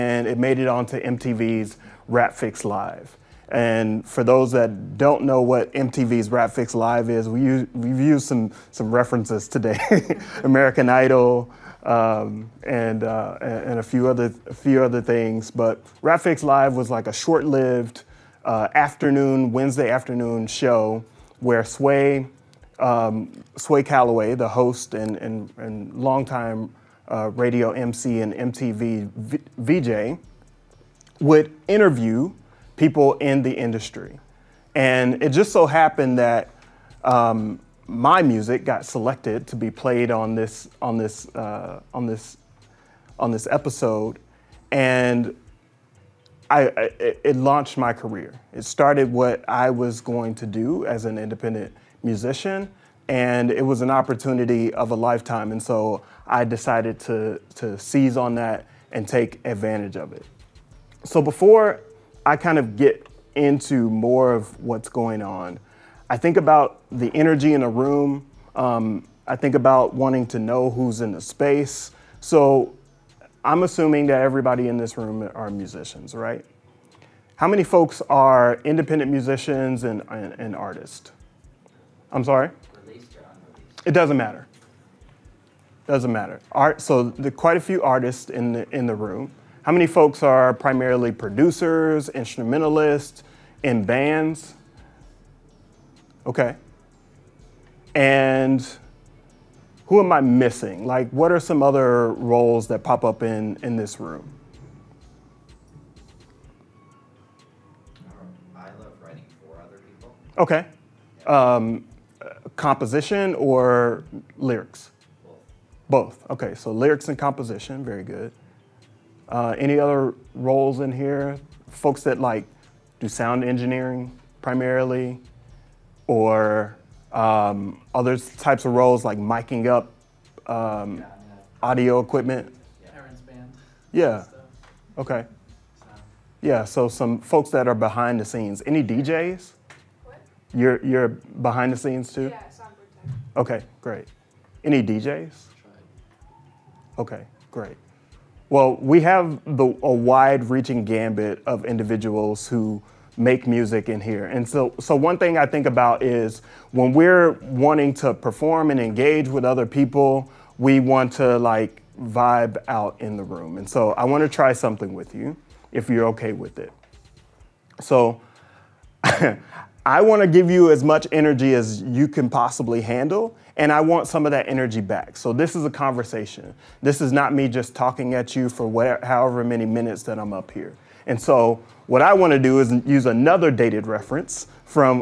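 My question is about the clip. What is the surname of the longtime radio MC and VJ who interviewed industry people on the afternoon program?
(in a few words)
Calloway.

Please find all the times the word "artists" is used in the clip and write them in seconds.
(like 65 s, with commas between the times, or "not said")
80 s, 87 s.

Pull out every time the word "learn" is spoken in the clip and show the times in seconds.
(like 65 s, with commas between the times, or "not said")
not said.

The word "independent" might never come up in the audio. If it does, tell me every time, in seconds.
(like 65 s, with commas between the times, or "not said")
51 s, 78 s.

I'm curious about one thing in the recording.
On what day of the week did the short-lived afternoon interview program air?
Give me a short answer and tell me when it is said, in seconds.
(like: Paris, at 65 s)
Wednesday, at 19 s.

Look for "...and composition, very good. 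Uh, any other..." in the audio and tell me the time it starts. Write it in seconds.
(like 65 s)
117 s.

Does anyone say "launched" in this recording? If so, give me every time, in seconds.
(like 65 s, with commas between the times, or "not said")
47 s.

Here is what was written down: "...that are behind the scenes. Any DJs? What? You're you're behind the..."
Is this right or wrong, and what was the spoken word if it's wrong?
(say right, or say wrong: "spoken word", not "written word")
right.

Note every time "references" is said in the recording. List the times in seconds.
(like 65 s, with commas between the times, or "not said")
8 s, 183 s.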